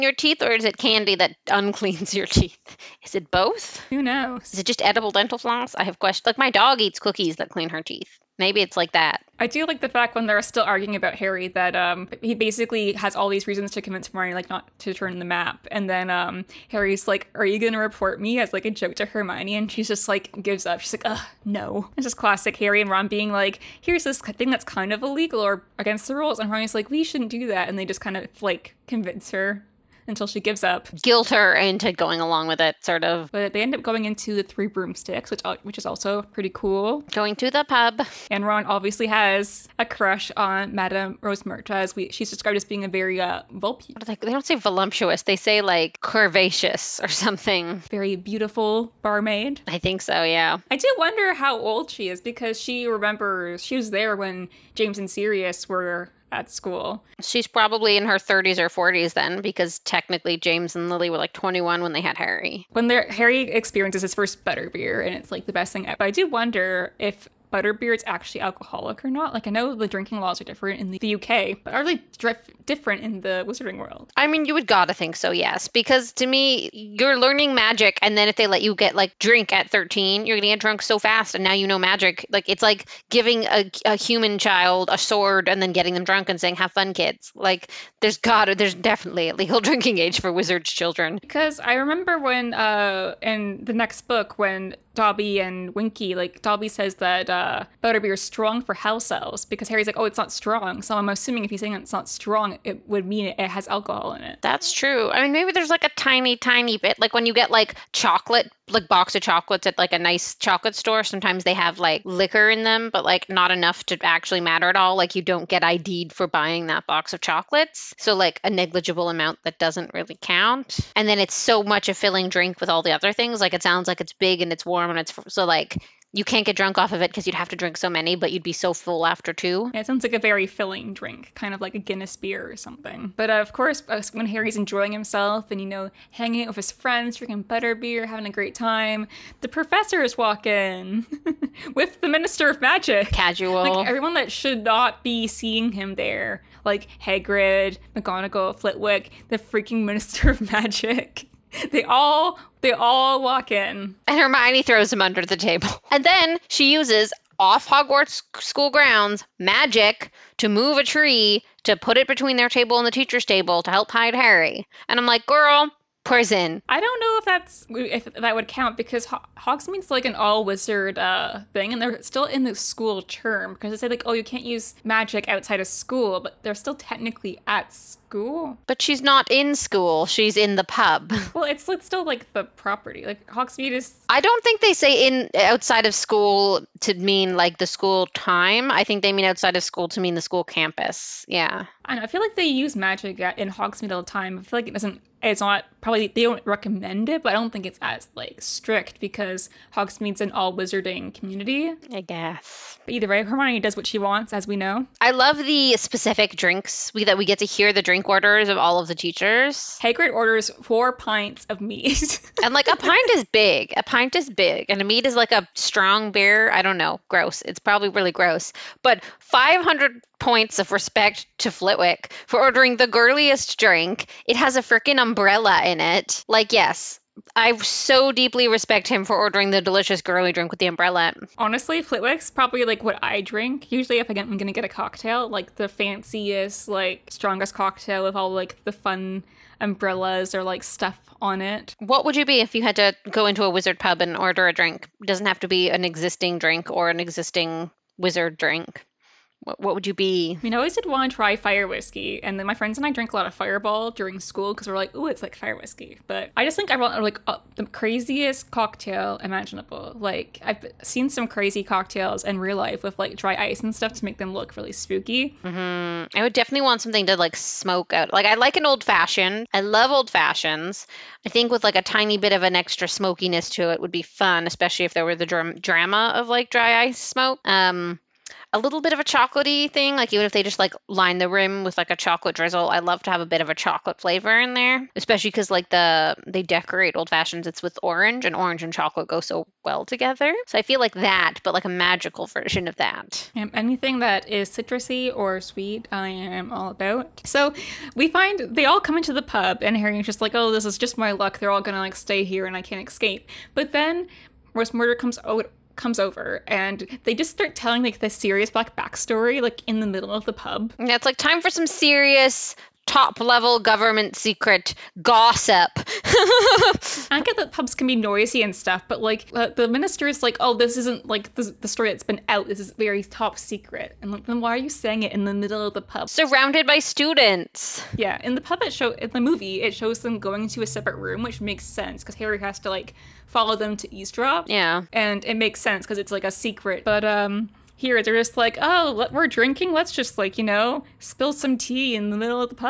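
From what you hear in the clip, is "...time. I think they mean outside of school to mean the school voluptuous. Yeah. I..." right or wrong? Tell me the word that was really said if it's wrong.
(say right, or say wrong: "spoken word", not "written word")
wrong: "campus", not "voluptuous".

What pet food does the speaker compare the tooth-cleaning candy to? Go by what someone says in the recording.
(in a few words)
Cookies.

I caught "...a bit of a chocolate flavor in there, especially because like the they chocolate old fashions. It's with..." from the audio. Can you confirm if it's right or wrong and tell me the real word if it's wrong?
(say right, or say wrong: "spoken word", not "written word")
wrong: "decorate", not "chocolate".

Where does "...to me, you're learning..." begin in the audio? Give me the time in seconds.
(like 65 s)
76 s.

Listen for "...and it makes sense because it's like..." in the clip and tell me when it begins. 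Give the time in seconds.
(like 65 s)
334 s.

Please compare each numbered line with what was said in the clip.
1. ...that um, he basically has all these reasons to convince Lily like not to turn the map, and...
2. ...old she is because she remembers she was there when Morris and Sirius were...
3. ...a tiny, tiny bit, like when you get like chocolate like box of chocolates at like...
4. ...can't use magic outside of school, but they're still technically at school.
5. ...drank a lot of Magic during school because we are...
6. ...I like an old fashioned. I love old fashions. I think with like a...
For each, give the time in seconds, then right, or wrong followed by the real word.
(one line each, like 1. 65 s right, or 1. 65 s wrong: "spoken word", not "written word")
1. 11 s wrong: "Hermione", not "Lily"
2. 51 s wrong: "James", not "Morris"
3. 105 s right
4. 174 s right
5. 252 s wrong: "Fireball", not "Magic"
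6. 268 s right.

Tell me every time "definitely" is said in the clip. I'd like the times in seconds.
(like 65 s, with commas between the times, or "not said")
88 s, 266 s.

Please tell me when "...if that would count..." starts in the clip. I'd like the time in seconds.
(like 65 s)
167 s.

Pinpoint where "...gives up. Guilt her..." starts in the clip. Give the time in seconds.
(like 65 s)
30 s.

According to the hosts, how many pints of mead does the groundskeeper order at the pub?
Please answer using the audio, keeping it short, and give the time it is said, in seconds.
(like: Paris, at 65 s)
4, at 210 s.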